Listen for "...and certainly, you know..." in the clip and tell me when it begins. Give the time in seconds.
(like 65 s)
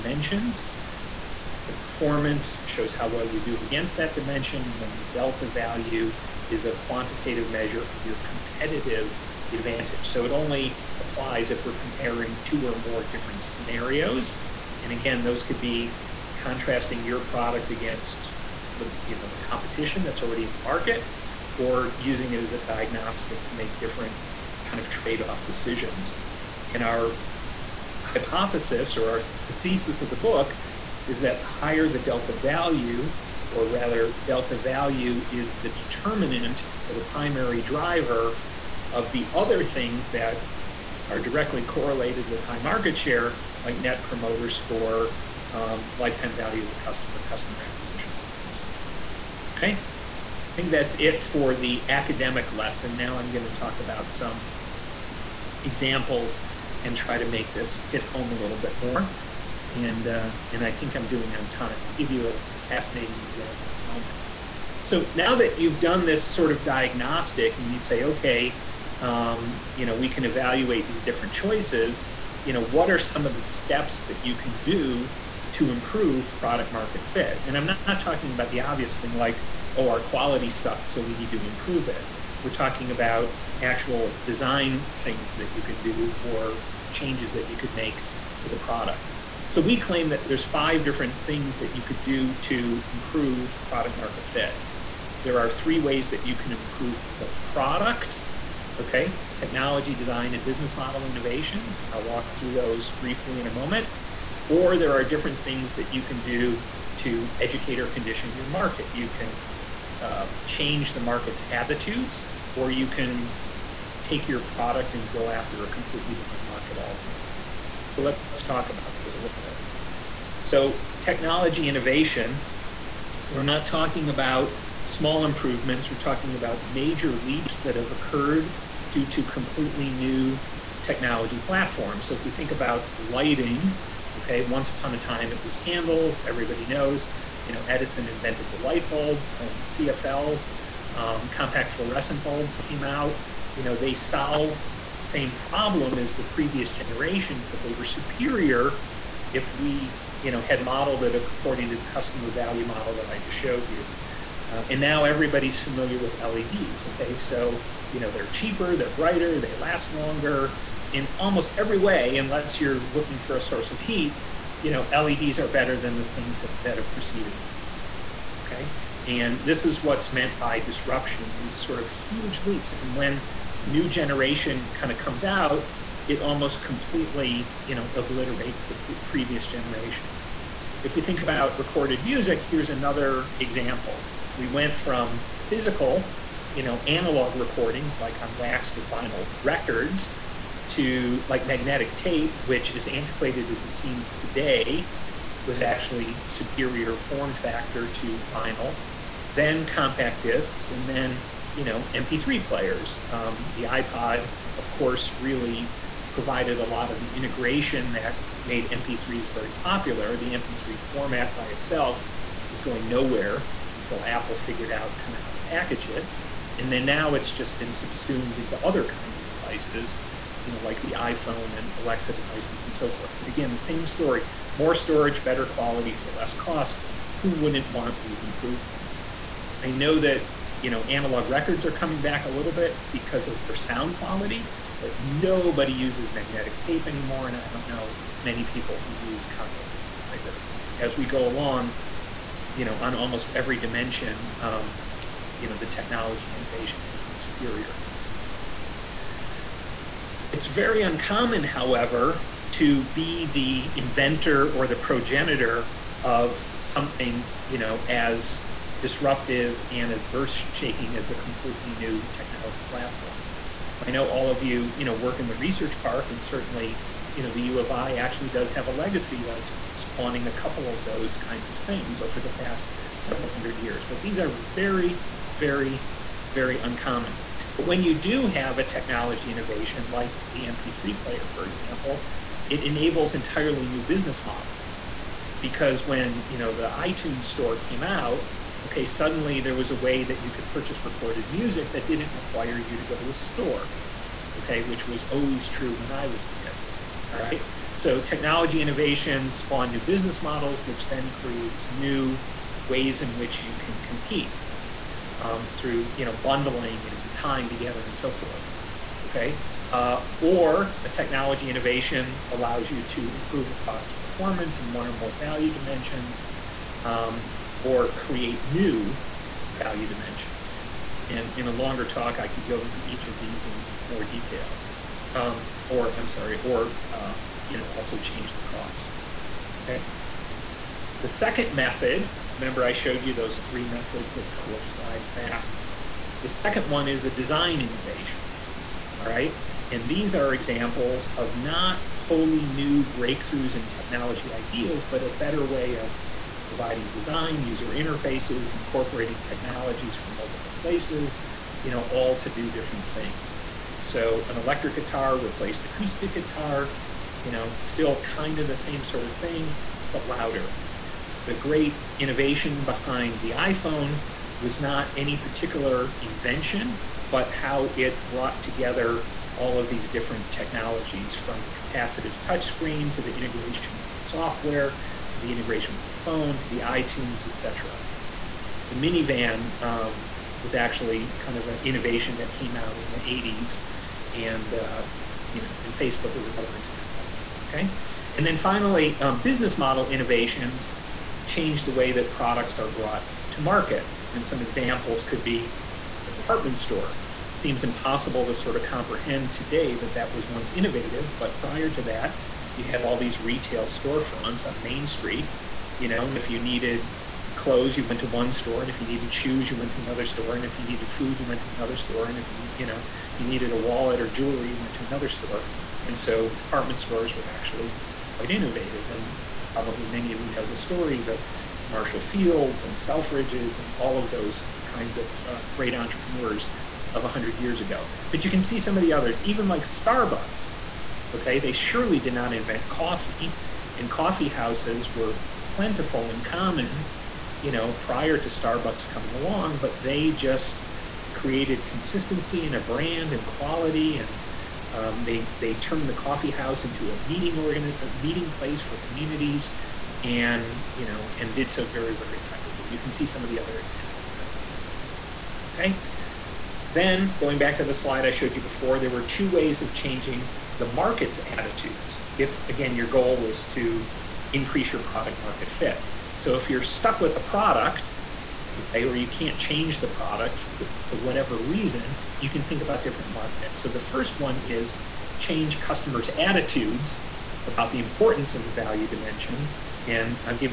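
266 s.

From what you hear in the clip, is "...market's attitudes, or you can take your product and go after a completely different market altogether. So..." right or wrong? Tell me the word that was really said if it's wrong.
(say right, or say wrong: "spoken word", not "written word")
right.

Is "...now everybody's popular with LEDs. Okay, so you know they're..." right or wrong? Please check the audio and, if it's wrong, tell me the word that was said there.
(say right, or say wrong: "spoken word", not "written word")
wrong: "familiar", not "popular".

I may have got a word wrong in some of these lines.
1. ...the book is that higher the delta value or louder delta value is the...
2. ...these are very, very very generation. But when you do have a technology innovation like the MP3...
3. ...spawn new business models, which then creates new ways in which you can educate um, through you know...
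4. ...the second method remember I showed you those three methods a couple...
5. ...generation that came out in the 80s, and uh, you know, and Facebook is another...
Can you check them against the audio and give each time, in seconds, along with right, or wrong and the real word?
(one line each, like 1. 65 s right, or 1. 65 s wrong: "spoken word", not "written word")
1. 30 s wrong: "rather", not "louder"
2. 274 s wrong: "uncommon", not "generation"
3. 299 s wrong: "compete", not "educate"
4. 331 s right
5. 381 s wrong: "innovation", not "generation".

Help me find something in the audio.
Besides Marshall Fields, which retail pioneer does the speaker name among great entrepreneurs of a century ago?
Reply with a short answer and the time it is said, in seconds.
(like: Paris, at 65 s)
Selfridges, at 422 s.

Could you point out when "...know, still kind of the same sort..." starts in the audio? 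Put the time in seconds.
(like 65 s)
357 s.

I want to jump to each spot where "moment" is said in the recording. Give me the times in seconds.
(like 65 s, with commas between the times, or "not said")
63 s, 103 s.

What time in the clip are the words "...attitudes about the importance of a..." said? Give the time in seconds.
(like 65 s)
476 s.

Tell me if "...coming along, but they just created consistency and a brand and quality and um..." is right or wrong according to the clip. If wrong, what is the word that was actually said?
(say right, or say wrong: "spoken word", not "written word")
right.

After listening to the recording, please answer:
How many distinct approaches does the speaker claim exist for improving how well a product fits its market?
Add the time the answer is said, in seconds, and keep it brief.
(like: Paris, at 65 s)
5, at 90 s.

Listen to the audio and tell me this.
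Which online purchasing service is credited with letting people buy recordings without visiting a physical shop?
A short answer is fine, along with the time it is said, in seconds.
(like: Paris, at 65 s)
iTunes store, at 286 s.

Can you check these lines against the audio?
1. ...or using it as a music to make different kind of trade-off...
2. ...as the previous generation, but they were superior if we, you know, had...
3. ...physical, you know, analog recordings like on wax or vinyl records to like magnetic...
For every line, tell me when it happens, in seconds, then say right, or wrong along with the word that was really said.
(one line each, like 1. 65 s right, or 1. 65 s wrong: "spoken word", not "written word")
1. 21 s wrong: "diagnostic", not "music"
2. 145 s right
3. 185 s right.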